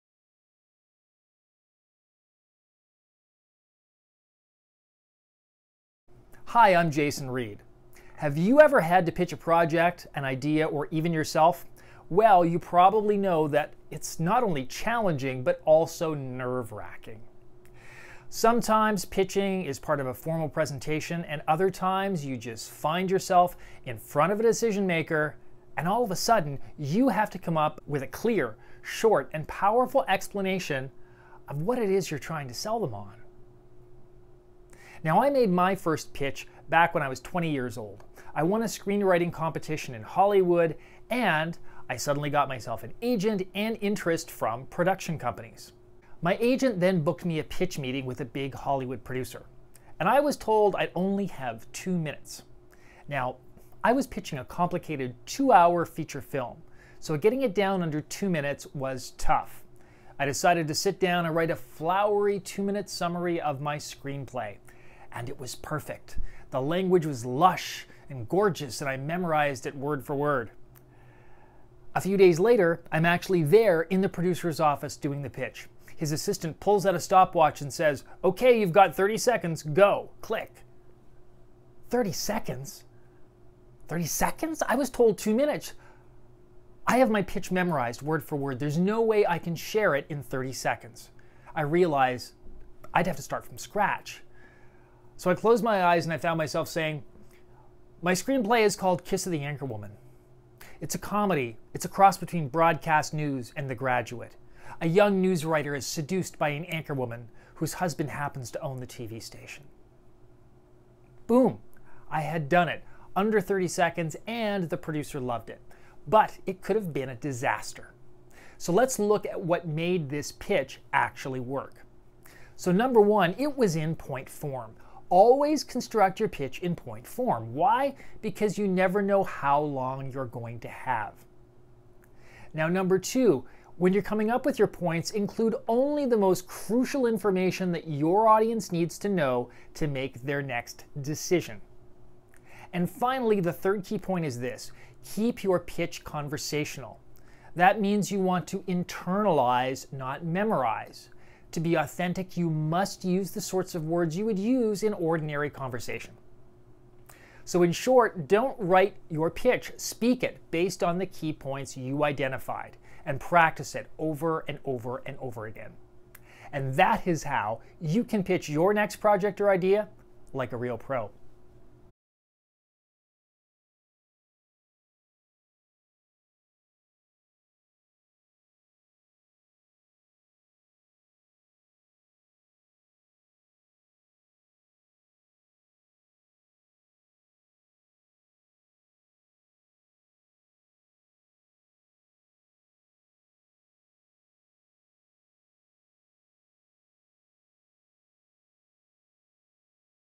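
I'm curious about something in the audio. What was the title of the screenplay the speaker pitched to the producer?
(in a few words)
Kiss of the Anchor Woman.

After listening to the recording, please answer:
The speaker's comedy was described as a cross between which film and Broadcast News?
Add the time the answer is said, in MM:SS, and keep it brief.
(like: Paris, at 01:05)
The Graduate, at 01:43.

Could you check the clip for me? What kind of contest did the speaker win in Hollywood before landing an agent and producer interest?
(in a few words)
Screenwriting competition.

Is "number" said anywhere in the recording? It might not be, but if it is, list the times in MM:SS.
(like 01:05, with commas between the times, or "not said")
02:02, 02:12.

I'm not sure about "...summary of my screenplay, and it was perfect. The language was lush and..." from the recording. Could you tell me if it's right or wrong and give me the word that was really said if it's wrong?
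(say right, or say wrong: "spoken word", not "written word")
right.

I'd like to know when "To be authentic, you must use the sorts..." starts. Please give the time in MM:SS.
02:31.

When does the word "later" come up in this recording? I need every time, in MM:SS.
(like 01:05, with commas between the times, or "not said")
01:12.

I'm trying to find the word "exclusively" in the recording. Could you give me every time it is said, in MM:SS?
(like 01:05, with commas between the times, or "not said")
not said.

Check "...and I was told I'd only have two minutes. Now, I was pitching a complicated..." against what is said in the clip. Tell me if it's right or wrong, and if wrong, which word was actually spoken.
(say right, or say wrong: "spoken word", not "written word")
right.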